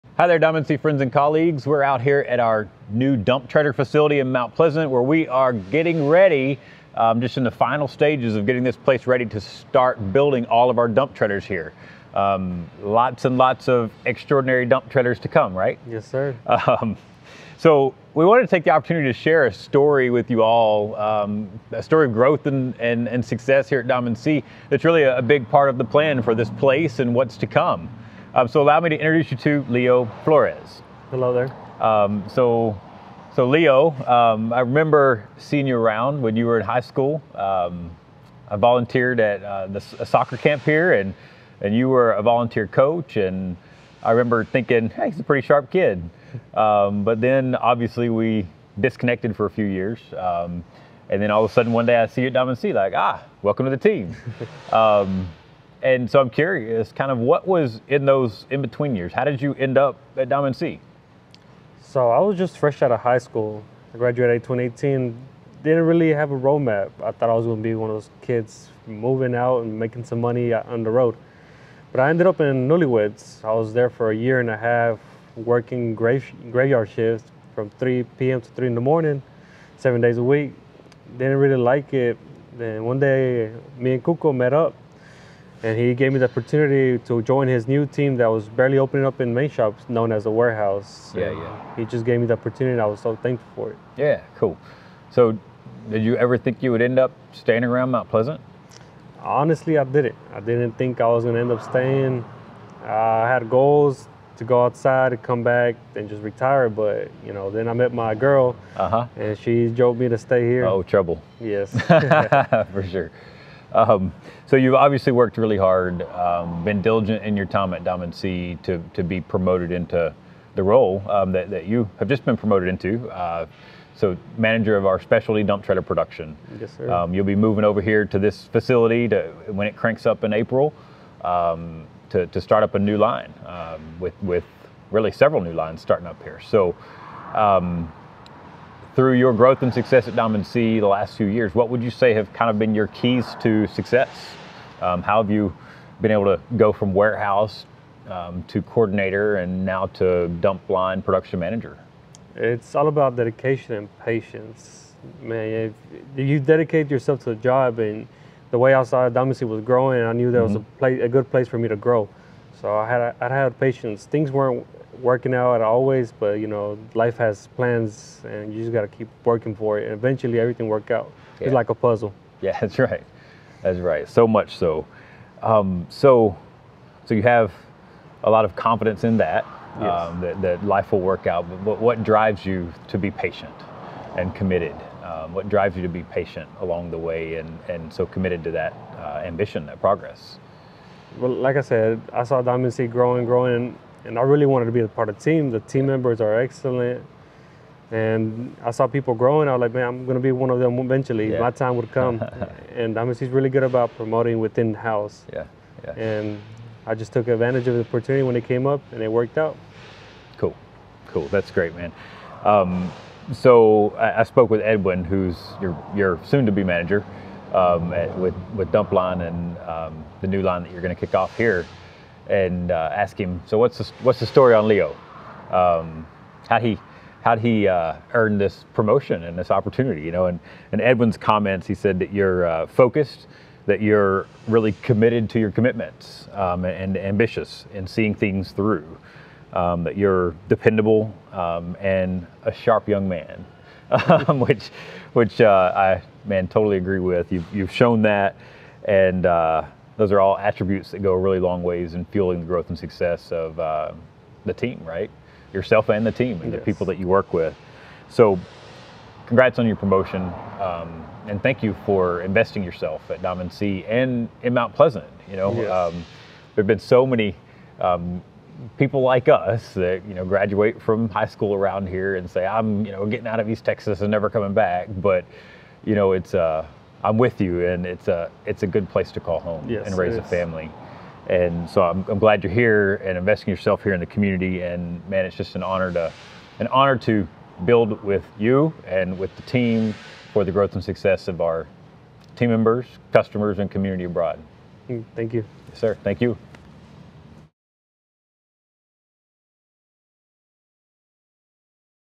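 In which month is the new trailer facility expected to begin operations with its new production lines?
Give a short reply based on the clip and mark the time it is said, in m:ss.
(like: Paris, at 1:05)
April, at 2:10.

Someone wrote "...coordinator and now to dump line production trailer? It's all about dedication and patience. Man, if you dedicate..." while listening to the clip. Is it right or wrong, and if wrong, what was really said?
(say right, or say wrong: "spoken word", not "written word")
wrong: "manager", not "trailer".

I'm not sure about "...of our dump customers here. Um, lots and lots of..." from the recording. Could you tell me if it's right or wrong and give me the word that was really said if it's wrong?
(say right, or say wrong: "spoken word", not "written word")
wrong: "trailers", not "customers".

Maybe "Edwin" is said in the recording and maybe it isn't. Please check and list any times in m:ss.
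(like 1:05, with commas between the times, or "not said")
3:34, 3:50.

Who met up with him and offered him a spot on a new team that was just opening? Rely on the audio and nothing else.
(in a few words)
Kuko.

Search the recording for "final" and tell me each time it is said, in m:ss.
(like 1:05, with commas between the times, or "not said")
0:07.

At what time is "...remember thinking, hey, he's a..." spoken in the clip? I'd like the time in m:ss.
0:44.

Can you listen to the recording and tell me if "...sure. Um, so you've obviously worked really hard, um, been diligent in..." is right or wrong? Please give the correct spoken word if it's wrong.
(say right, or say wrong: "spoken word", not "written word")
right.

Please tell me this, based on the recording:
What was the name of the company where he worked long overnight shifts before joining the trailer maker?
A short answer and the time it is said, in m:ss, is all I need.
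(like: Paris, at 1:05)
Newly Weds, at 1:12.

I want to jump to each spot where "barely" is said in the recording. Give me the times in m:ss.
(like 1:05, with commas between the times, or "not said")
1:28.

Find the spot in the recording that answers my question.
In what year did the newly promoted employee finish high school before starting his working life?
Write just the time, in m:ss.
1:04.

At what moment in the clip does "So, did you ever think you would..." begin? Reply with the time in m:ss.
1:35.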